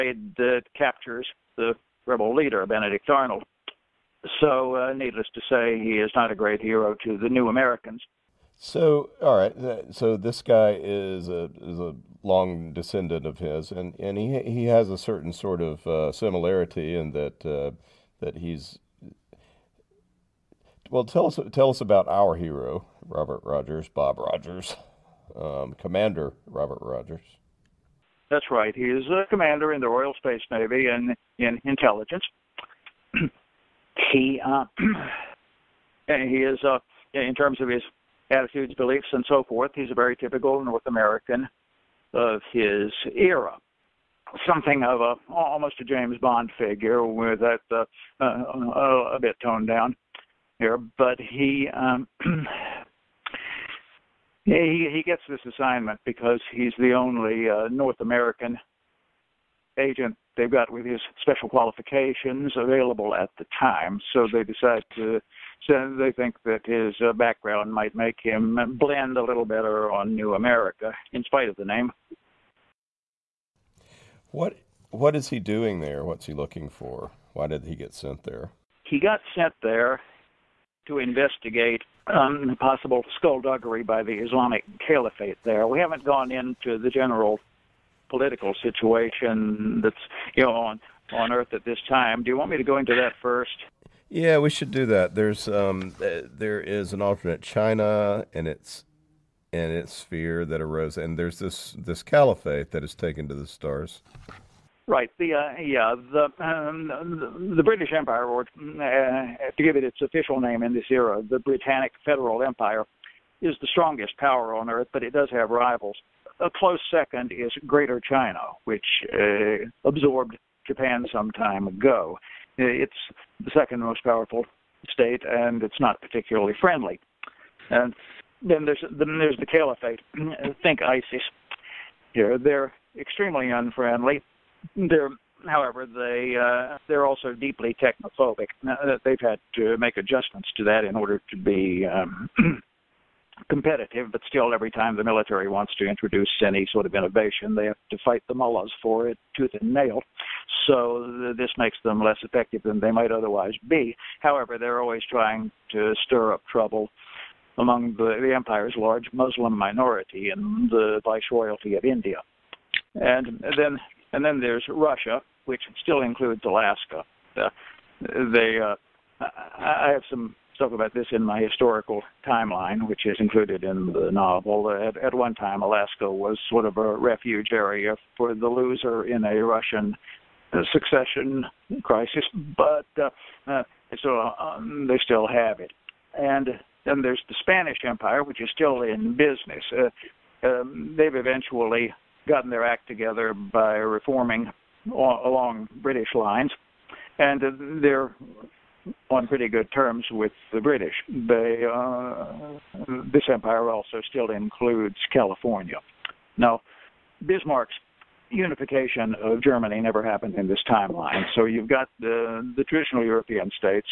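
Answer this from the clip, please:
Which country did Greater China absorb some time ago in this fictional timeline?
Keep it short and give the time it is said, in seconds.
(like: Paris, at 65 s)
Japan, at 120 s.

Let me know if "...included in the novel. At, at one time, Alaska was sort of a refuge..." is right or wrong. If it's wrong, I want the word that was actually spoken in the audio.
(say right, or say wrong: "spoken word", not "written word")
right.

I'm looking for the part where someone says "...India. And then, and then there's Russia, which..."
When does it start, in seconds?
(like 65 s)
161 s.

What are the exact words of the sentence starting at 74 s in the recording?
What what is he doing there?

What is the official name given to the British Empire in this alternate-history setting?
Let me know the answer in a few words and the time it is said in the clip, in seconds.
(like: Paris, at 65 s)
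Britannic Federal Empire, at 111 s.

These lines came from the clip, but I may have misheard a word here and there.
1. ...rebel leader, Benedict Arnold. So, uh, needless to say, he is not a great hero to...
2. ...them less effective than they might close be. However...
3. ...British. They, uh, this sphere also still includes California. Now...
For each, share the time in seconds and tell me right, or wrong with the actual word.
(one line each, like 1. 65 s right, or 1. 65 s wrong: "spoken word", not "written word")
1. 2 s right
2. 151 s wrong: "otherwise", not "close"
3. 200 s wrong: "empire", not "sphere".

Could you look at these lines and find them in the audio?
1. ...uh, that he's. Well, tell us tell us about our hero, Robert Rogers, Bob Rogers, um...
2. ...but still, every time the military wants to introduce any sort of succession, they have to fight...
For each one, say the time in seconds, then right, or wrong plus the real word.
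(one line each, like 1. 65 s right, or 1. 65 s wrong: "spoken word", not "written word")
1. 17 s right
2. 144 s wrong: "innovation", not "succession".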